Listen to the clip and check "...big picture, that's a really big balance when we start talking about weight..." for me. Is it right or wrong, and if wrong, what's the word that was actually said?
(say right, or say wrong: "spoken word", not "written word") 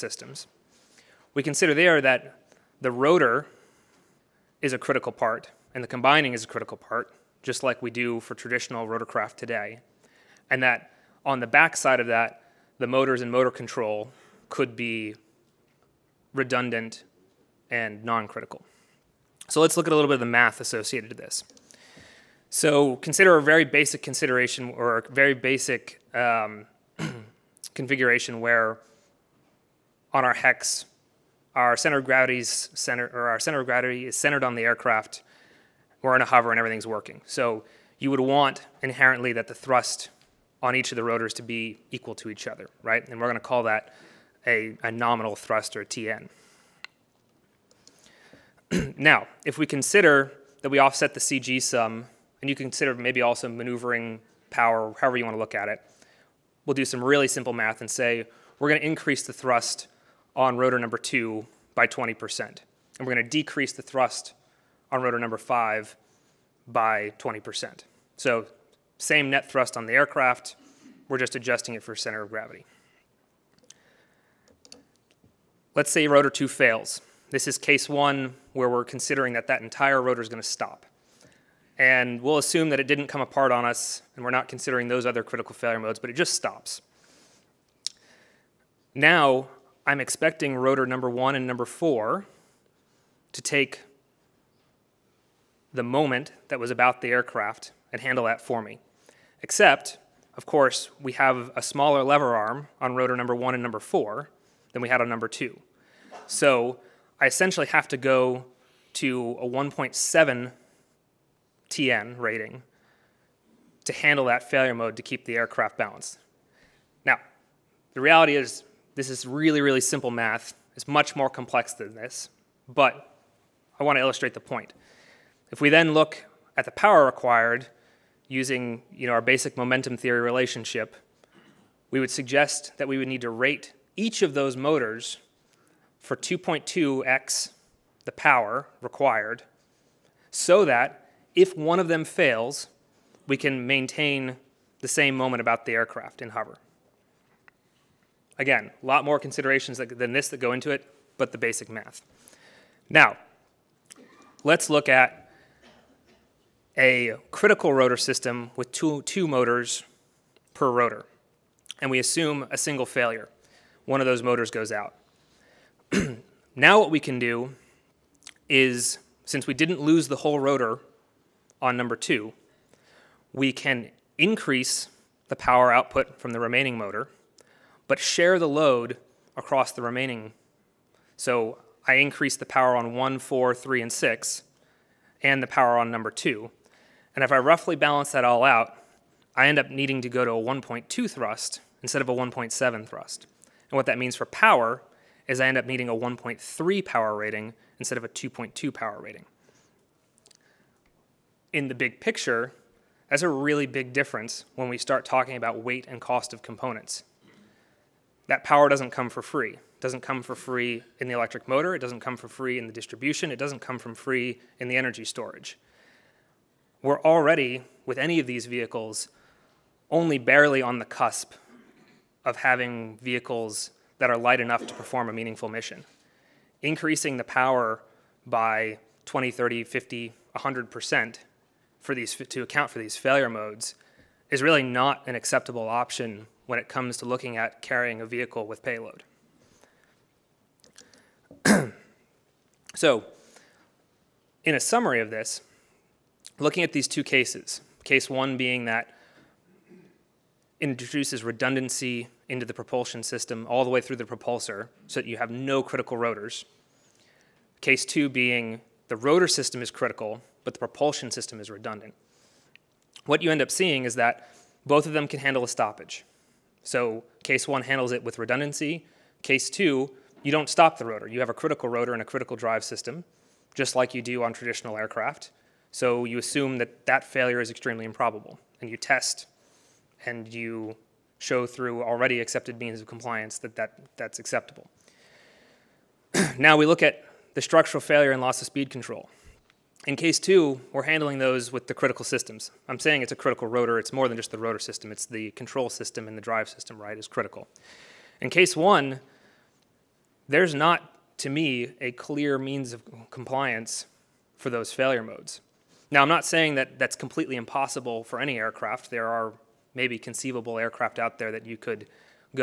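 wrong: "difference", not "balance".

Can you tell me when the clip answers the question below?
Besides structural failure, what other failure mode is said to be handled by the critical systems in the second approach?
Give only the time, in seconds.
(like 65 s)
288 s.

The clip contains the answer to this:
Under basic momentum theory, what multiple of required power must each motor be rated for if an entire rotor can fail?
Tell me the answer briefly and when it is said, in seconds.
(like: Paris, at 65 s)
2.2x, at 136 s.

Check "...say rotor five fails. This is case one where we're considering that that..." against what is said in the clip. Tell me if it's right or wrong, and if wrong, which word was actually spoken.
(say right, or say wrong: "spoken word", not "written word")
wrong: "two", not "five".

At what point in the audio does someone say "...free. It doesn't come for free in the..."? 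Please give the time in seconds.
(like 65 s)
209 s.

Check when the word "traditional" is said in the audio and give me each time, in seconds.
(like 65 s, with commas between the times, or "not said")
8 s, 274 s.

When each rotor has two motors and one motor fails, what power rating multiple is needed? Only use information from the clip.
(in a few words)
1.3.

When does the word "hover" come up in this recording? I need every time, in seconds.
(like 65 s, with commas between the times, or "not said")
36 s, 146 s.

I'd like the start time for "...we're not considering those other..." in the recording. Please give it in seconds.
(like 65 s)
84 s.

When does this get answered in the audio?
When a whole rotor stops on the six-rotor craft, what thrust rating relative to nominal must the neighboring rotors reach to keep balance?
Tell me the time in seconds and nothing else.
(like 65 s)
109 s.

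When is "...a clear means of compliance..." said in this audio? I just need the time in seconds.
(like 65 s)
301 s.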